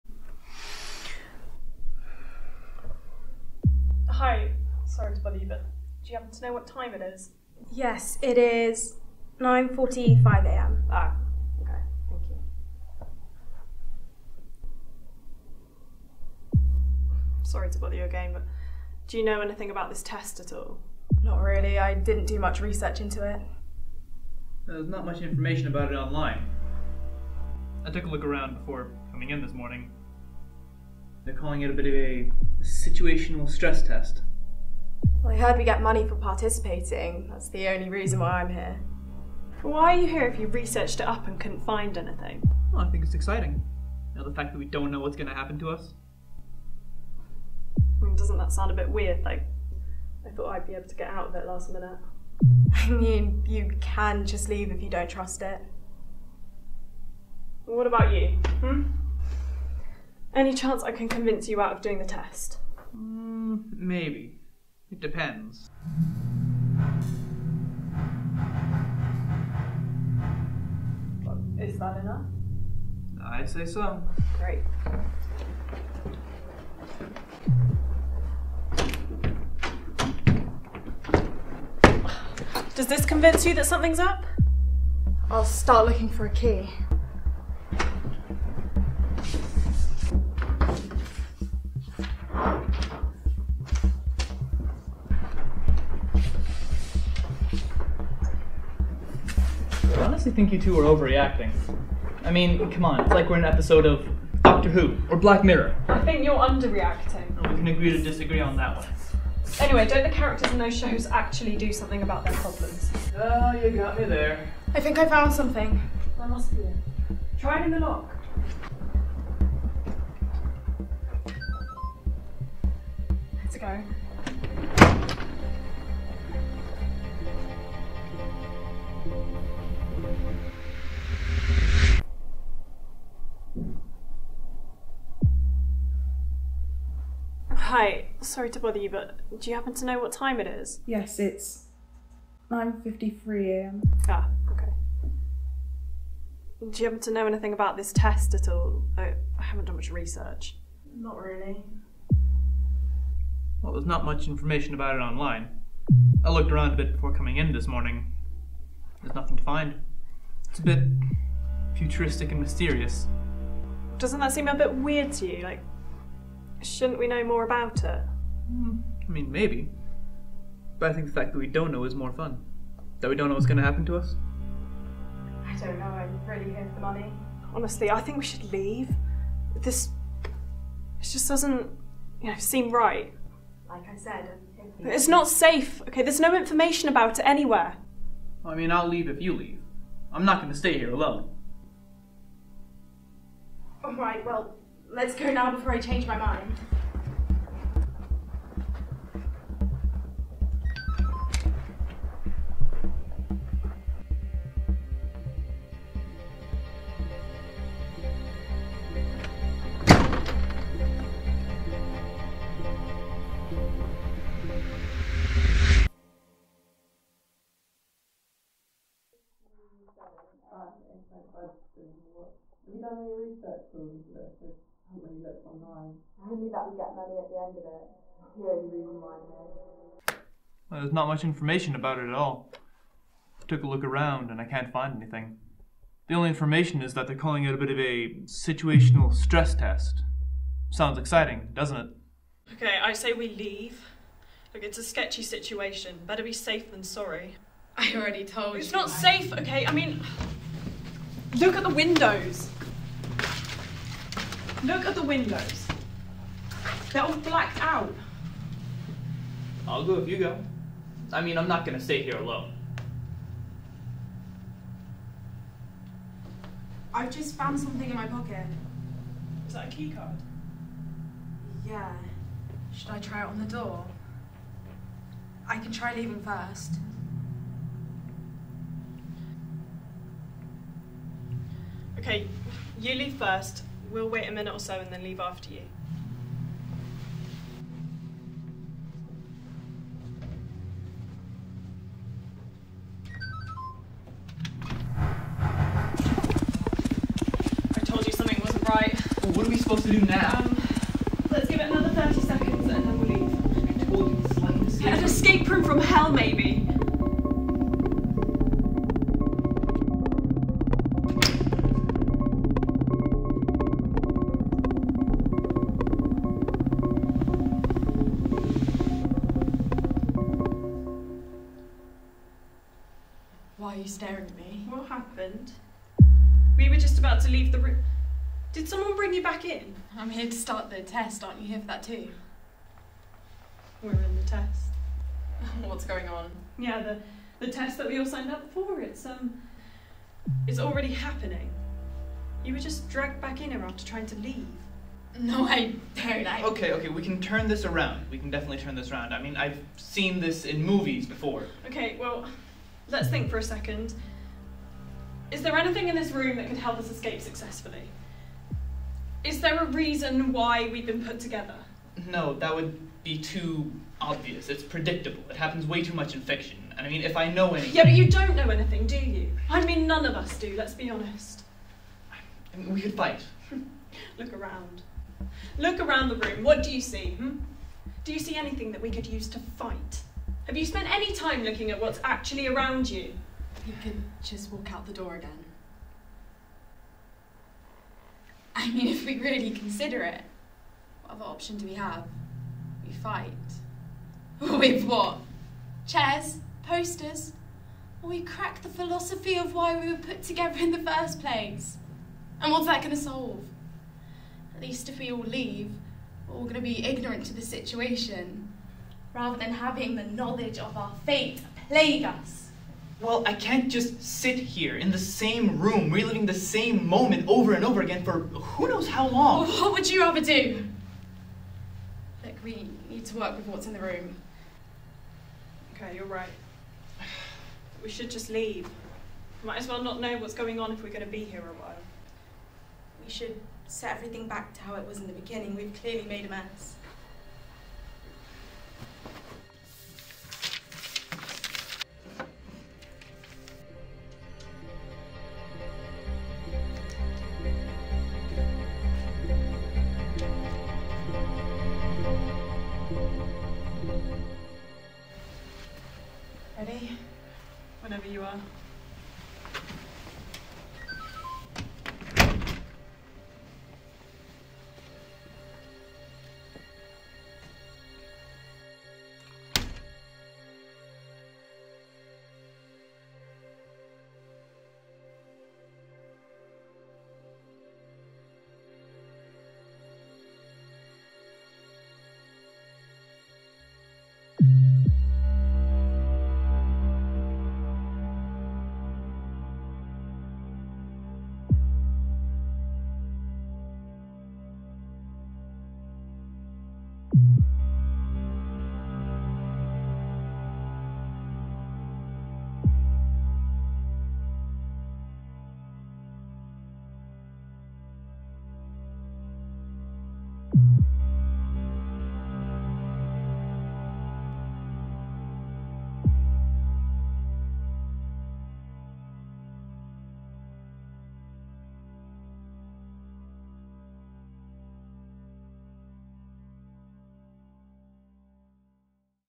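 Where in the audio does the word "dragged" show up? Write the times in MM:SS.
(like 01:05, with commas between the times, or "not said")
05:42.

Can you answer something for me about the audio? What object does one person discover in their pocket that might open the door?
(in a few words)
a keycard.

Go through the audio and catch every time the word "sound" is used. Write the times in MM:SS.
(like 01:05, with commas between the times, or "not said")
00:48, 04:00.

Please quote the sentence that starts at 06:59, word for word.
Well, what would you rather do?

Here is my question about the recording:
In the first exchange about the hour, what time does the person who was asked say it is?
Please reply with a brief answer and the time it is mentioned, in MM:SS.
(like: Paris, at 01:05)
9.45 a.m., at 00:09.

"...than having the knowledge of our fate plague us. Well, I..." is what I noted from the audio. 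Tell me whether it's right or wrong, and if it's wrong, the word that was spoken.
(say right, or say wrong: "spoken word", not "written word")
right.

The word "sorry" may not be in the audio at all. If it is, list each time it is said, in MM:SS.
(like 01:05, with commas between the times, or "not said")
00:04, 00:17, 02:18, 04:06.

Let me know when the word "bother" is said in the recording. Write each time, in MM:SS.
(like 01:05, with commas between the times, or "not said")
00:05, 00:17, 02:18.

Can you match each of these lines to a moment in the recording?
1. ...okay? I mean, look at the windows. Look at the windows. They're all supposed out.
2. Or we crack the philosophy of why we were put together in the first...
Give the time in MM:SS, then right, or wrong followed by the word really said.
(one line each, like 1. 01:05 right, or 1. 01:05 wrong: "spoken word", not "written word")
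1. 04:09 wrong: "blacked", not "supposed"
2. 06:38 right.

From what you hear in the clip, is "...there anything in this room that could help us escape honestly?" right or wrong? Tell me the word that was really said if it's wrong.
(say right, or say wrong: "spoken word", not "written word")
wrong: "successfully", not "honestly".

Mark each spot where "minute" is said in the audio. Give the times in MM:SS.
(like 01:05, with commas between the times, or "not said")
00:51, 04:44.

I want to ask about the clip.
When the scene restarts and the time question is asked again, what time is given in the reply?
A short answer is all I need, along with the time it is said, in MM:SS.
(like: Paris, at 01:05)
9.53 am, at 02:22.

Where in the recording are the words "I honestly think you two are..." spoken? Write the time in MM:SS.
01:39.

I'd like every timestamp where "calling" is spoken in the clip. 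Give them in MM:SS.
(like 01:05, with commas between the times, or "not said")
00:31, 03:57.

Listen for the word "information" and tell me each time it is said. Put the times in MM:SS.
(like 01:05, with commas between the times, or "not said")
00:25, 02:34, 03:06, 03:51, 03:56.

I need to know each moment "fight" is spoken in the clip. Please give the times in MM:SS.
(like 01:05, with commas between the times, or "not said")
06:12, 06:19, 06:32.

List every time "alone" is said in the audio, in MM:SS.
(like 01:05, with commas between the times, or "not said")
03:10, 04:22.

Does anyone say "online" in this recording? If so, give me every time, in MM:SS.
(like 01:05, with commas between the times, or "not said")
00:25, 02:34.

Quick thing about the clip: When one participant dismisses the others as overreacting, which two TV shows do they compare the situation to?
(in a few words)
Doctor Who or Black Mirror.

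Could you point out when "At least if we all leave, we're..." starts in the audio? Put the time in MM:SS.
06:44.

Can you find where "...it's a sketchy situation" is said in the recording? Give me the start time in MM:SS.
04:04.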